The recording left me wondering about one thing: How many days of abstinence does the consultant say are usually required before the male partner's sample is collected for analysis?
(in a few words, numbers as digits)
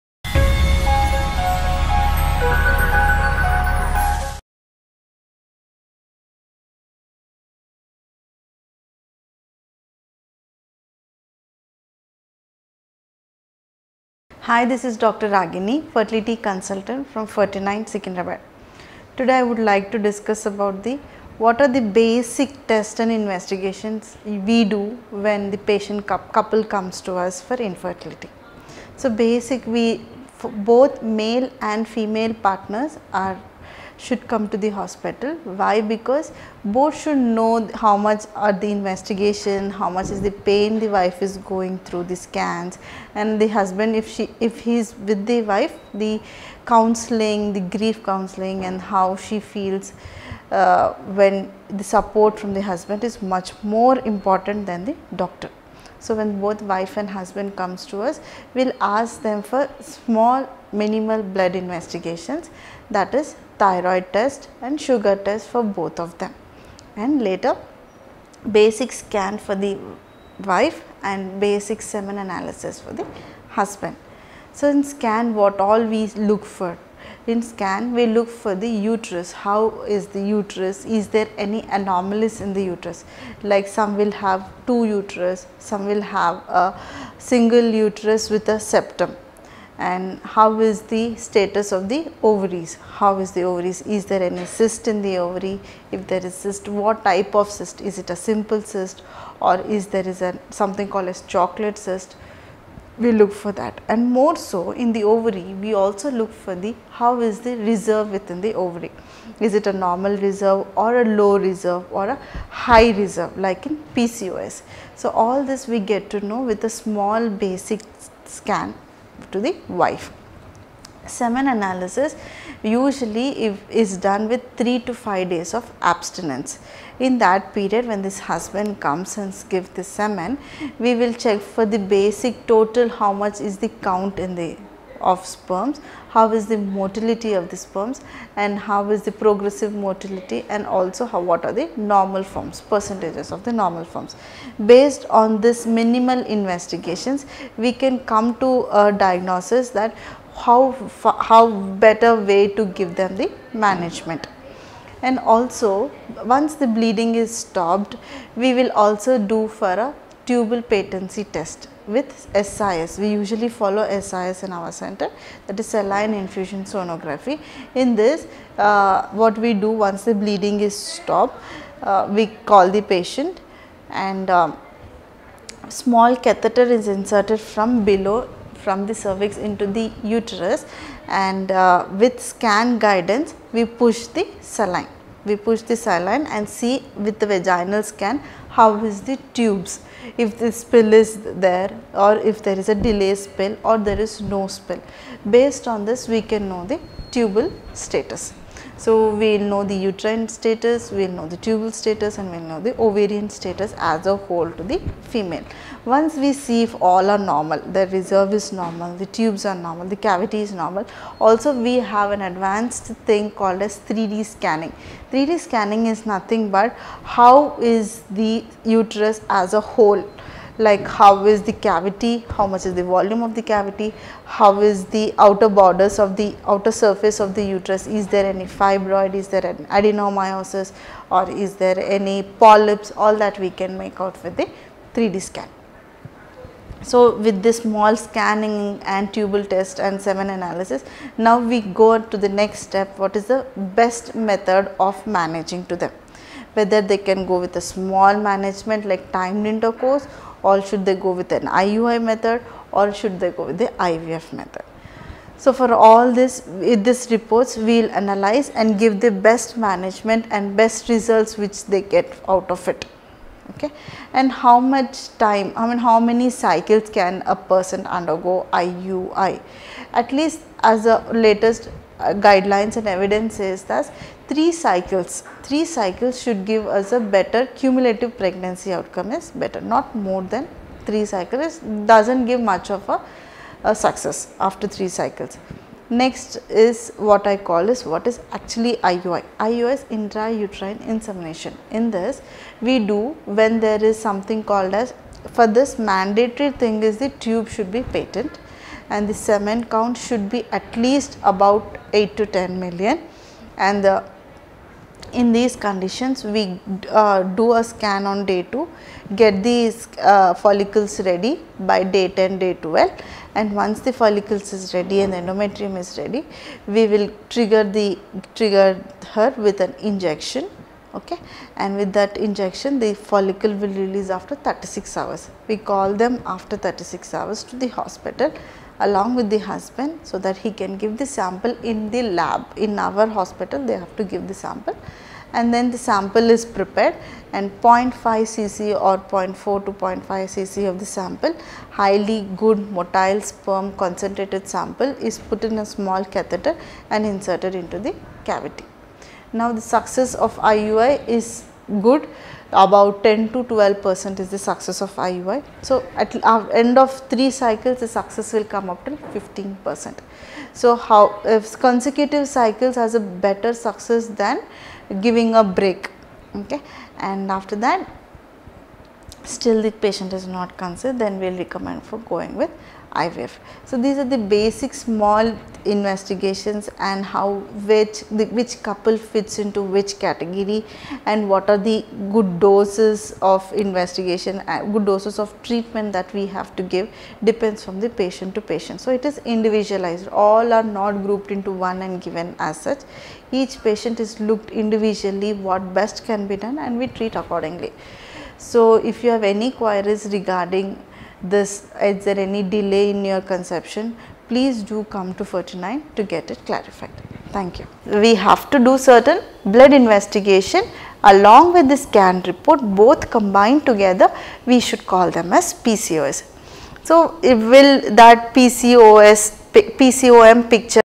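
3 to 5 days.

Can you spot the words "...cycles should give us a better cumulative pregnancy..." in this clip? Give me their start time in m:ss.
4:35.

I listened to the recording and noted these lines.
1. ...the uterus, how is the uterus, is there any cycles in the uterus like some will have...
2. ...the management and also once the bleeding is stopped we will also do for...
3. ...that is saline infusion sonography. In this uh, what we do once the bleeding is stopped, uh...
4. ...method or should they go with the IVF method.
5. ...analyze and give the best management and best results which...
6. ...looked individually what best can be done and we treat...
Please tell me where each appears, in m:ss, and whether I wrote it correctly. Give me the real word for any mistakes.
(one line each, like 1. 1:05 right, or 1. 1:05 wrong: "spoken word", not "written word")
1. 1:18 wrong: "anomalies", not "cycles"
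2. 2:33 right
3. 2:45 right
4. 4:12 right
5. 4:17 right
6. 6:34 right.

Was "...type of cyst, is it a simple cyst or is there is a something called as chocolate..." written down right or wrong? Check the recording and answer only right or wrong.
right.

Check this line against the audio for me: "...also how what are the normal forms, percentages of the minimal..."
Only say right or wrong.
wrong.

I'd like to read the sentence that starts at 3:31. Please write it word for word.
Also we have an advanced thing called as 3D scanning.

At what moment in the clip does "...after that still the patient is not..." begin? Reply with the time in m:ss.
6:07.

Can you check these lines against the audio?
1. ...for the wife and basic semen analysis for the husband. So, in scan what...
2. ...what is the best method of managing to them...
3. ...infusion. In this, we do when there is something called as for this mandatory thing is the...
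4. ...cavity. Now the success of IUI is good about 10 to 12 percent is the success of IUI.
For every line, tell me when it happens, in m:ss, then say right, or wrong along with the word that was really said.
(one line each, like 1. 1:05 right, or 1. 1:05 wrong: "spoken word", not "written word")
1. 1:09 right
2. 4:02 right
3. 4:50 wrong: "insemination", not "infusion"
4. 5:48 right.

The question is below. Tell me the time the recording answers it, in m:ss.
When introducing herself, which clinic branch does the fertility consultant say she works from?
0:17.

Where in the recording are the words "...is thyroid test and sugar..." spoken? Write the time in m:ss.
1:03.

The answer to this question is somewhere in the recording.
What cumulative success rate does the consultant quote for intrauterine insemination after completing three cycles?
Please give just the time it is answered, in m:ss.
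5:58.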